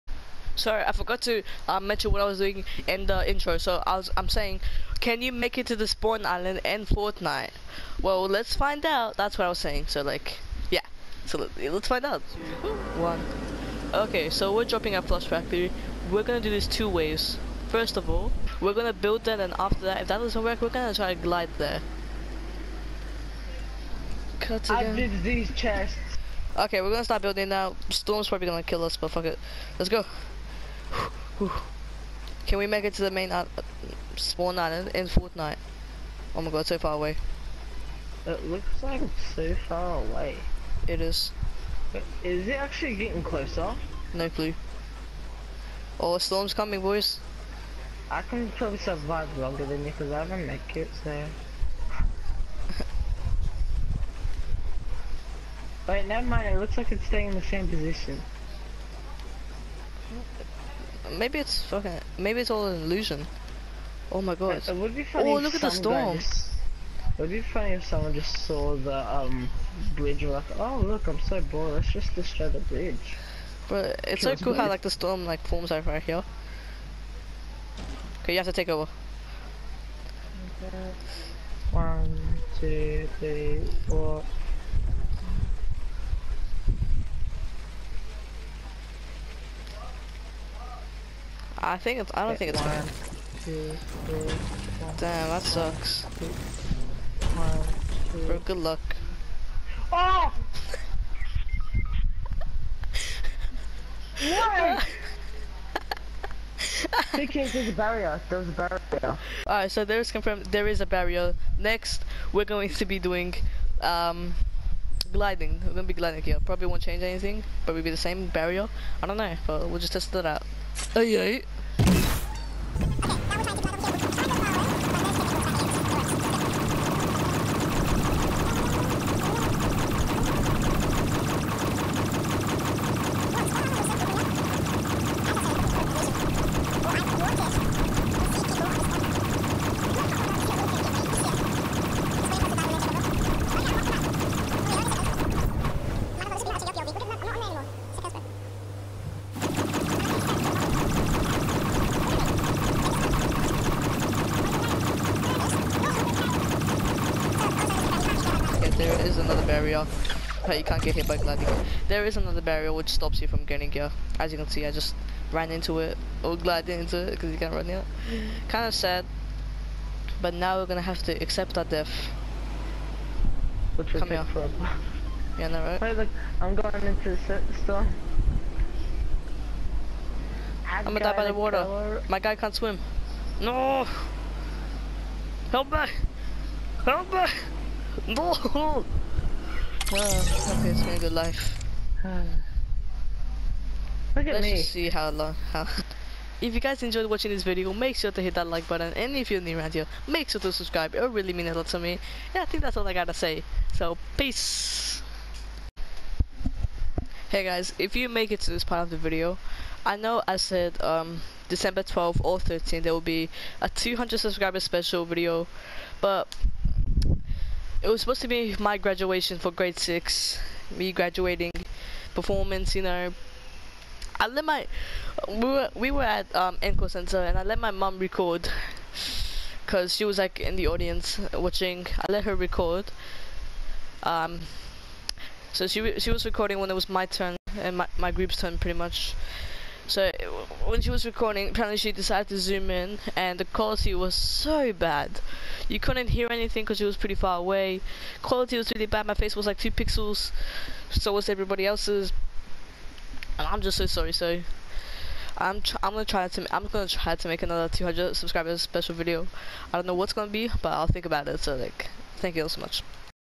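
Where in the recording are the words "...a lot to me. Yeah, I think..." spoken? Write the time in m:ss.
3:21.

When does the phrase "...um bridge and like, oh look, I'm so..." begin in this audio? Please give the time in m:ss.
1:09.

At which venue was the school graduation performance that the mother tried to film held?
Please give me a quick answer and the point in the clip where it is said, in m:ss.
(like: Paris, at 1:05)
Enco Center, at 3:46.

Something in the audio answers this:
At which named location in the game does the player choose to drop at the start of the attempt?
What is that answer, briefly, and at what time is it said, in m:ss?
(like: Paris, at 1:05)
Flush Factory, at 0:15.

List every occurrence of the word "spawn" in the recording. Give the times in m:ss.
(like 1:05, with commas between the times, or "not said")
0:05, 0:34.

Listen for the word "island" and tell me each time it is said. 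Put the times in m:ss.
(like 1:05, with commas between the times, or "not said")
0:06, 0:34.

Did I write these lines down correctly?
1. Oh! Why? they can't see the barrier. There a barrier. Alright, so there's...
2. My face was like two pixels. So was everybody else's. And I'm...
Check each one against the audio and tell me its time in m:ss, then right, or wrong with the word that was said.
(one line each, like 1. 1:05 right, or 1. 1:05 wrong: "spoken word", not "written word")
1. 1:39 right
2. 4:09 right.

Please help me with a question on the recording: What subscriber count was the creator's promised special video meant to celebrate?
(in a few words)
200.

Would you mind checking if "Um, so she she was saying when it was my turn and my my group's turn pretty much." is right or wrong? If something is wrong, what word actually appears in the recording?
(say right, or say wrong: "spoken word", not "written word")
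wrong: "recording", not "saying".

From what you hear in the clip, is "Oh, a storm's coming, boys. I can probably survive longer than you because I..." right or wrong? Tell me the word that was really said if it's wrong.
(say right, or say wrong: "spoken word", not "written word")
right.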